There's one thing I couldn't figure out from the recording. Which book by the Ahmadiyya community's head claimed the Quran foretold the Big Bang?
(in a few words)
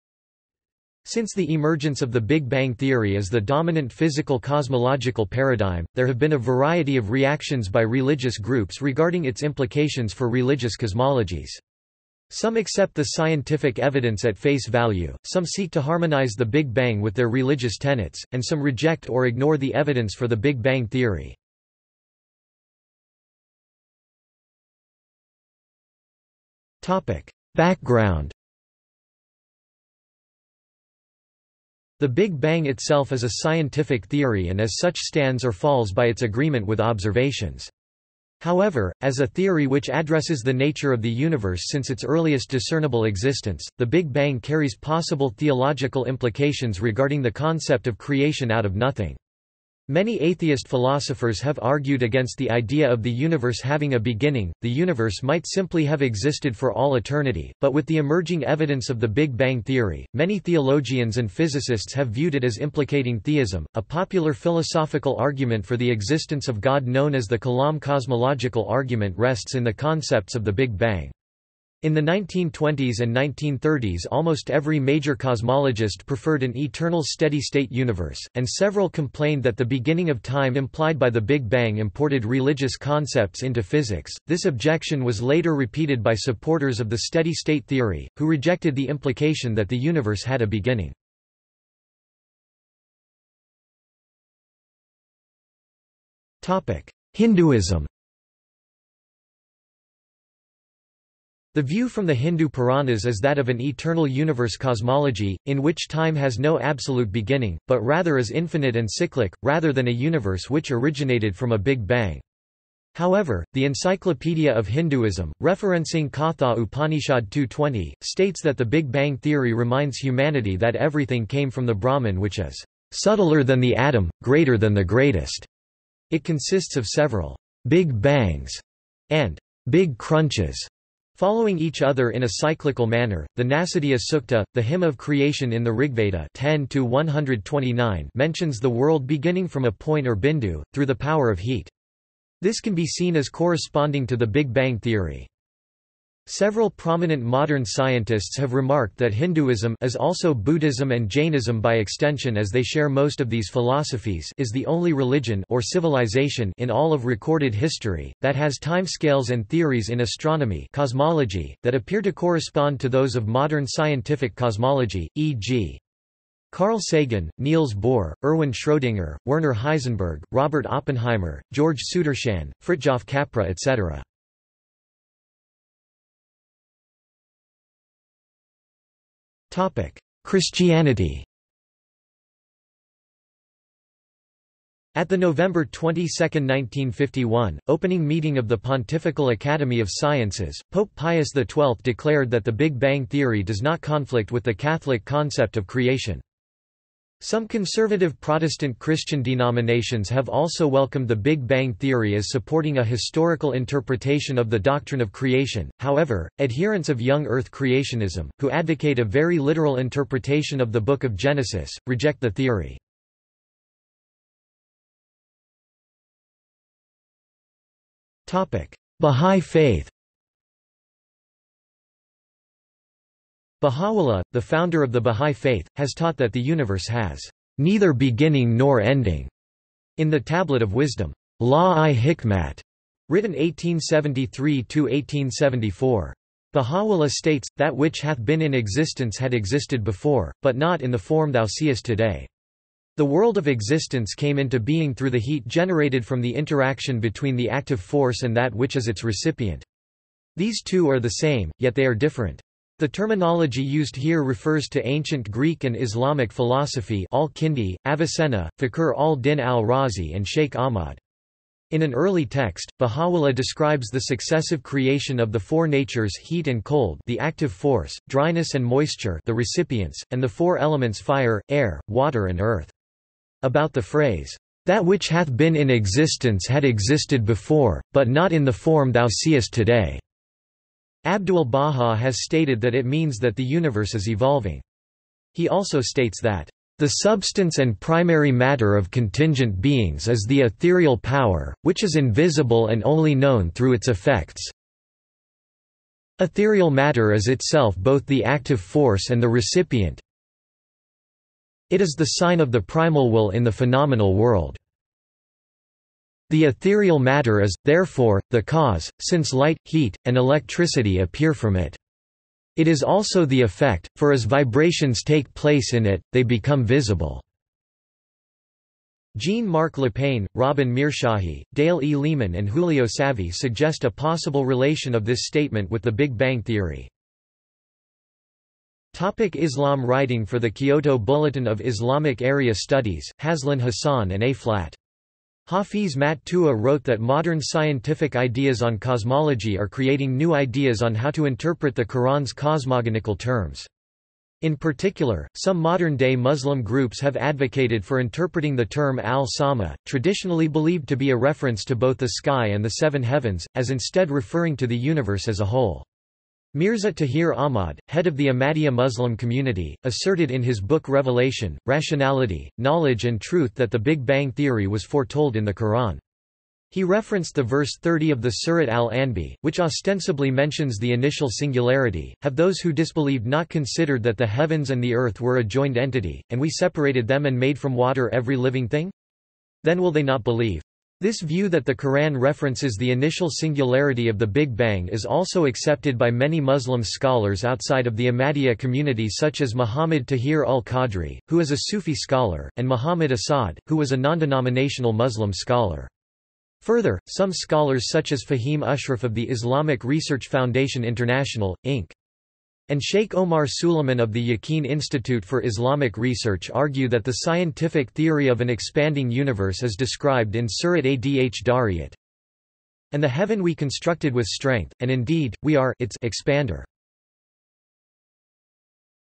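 Revelation, Rationality, Knowledge and Truth.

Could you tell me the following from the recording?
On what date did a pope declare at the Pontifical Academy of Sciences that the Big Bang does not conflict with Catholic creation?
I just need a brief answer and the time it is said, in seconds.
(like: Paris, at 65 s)
November 22, 1951, at 185 s.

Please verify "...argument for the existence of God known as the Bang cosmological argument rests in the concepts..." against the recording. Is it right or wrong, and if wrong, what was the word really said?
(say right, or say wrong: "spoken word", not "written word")
wrong: "Kalam", not "Bang".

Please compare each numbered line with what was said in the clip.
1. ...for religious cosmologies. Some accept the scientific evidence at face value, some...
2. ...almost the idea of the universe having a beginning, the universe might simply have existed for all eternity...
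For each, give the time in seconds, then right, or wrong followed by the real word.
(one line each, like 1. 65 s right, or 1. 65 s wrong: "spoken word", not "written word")
1. 10 s right
2. 52 s wrong: "against", not "almost".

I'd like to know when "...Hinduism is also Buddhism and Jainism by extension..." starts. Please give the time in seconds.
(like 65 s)
149 s.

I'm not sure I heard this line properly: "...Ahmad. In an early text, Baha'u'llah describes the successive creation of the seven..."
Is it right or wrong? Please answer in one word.
wrong.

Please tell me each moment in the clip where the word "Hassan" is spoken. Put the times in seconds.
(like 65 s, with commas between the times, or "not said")
333 s.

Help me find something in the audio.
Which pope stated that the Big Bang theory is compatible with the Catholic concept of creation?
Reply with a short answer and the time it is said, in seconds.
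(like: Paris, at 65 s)
Pope Pius XII, at 190 s.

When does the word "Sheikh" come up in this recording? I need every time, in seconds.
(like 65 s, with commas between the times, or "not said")
260 s, 402 s.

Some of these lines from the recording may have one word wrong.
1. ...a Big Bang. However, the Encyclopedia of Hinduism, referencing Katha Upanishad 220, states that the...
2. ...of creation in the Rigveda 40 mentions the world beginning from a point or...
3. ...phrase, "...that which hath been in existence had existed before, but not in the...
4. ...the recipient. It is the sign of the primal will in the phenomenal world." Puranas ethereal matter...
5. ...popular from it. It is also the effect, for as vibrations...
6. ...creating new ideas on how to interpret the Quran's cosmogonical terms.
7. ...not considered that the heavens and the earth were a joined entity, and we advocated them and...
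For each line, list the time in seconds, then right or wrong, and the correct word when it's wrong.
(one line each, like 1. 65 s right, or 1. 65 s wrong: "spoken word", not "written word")
1. 111 s right
2. 134 s wrong: "10", not "40"
3. 273 s right
4. 299 s wrong: "The", not "Puranas"
5. 310 s wrong: "appear", not "popular"
6. 339 s right
7. 373 s wrong: "separated", not "advocated".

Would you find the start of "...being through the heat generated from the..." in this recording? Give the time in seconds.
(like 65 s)
244 s.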